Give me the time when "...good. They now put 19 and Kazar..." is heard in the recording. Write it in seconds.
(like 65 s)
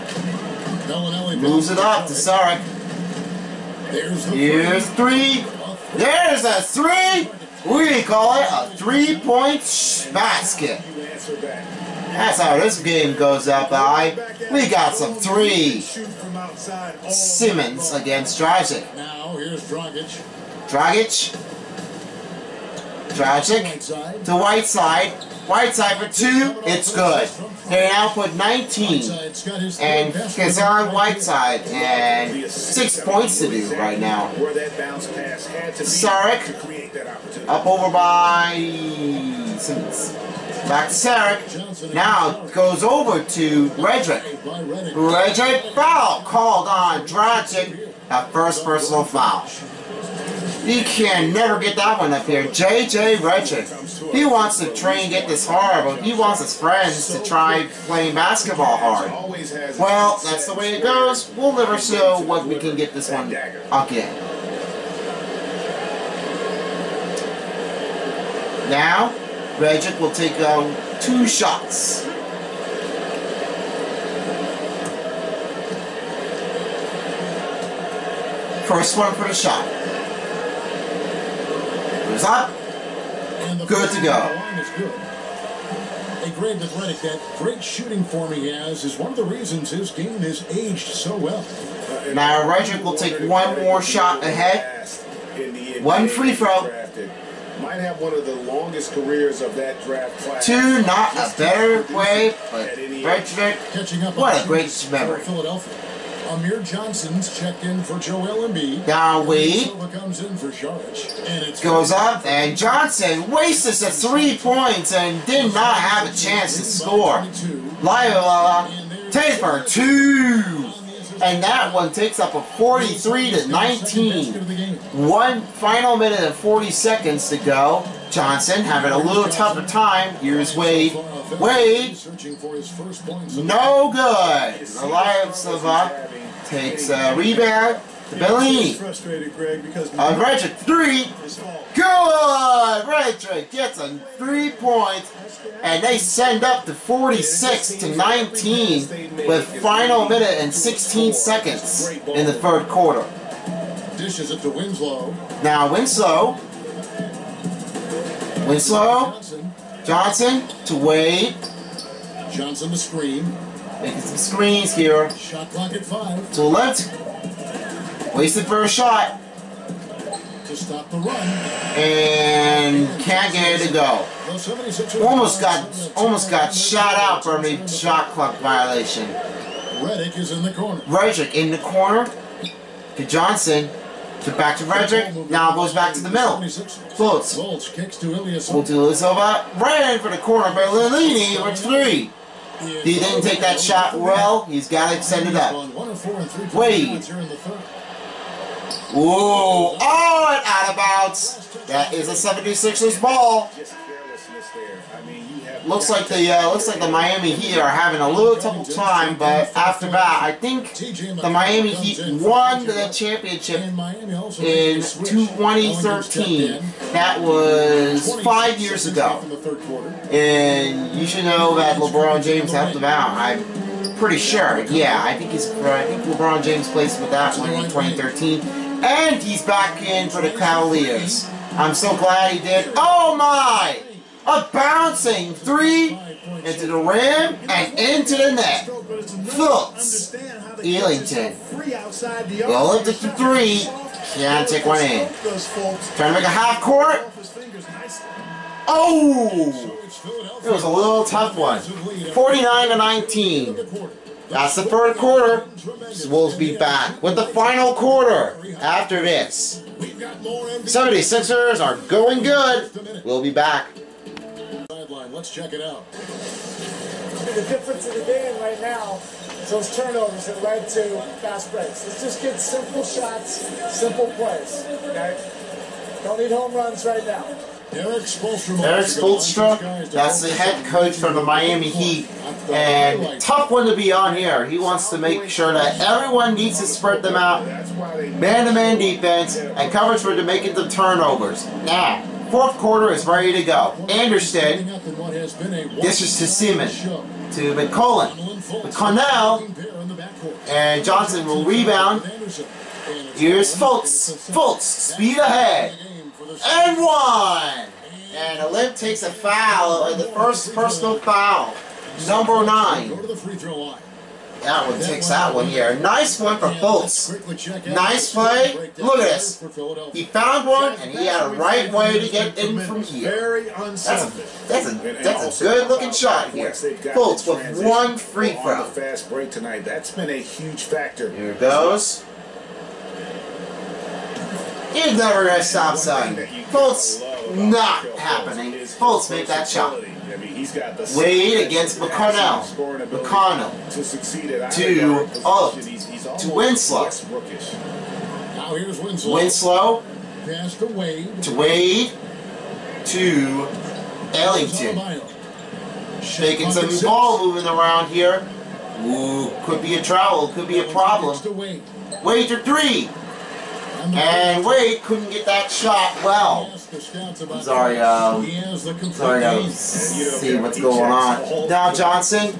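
26 s.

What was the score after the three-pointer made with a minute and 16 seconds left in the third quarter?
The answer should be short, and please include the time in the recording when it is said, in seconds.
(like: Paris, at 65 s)
46 to 19, at 146 s.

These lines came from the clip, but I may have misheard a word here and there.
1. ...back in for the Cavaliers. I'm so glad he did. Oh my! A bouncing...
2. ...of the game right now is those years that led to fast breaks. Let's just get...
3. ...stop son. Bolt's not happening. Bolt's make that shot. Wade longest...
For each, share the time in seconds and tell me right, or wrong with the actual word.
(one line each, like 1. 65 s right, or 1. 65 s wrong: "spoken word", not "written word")
1. 229 s right
2. 267 s wrong: "turnovers", not "years"
3. 335 s wrong: "against", not "longest".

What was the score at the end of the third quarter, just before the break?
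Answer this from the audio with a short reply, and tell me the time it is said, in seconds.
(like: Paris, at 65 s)
49 to 19, at 251 s.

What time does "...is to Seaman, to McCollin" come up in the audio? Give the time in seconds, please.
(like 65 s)
295 s.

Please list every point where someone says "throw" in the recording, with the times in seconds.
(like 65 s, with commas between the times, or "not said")
96 s, 328 s.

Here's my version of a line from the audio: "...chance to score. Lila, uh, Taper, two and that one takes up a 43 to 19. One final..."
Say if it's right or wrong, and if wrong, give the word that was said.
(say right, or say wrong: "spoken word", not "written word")
right.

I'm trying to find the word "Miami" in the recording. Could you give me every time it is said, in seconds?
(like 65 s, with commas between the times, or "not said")
206 s, 211 s, 281 s.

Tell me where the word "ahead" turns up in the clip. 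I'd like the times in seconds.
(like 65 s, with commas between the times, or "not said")
94 s, 305 s.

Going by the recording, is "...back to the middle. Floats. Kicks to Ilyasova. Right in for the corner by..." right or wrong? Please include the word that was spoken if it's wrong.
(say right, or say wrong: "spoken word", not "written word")
right.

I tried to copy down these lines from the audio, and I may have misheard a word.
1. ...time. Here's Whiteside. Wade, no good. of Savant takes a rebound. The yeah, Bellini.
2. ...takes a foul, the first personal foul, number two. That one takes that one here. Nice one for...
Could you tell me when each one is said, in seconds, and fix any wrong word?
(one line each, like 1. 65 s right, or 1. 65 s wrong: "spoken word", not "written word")
1. 129 s wrong: "Wade", not "Whiteside"
2. 308 s wrong: "nine", not "two".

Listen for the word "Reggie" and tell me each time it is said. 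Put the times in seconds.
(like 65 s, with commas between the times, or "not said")
92 s.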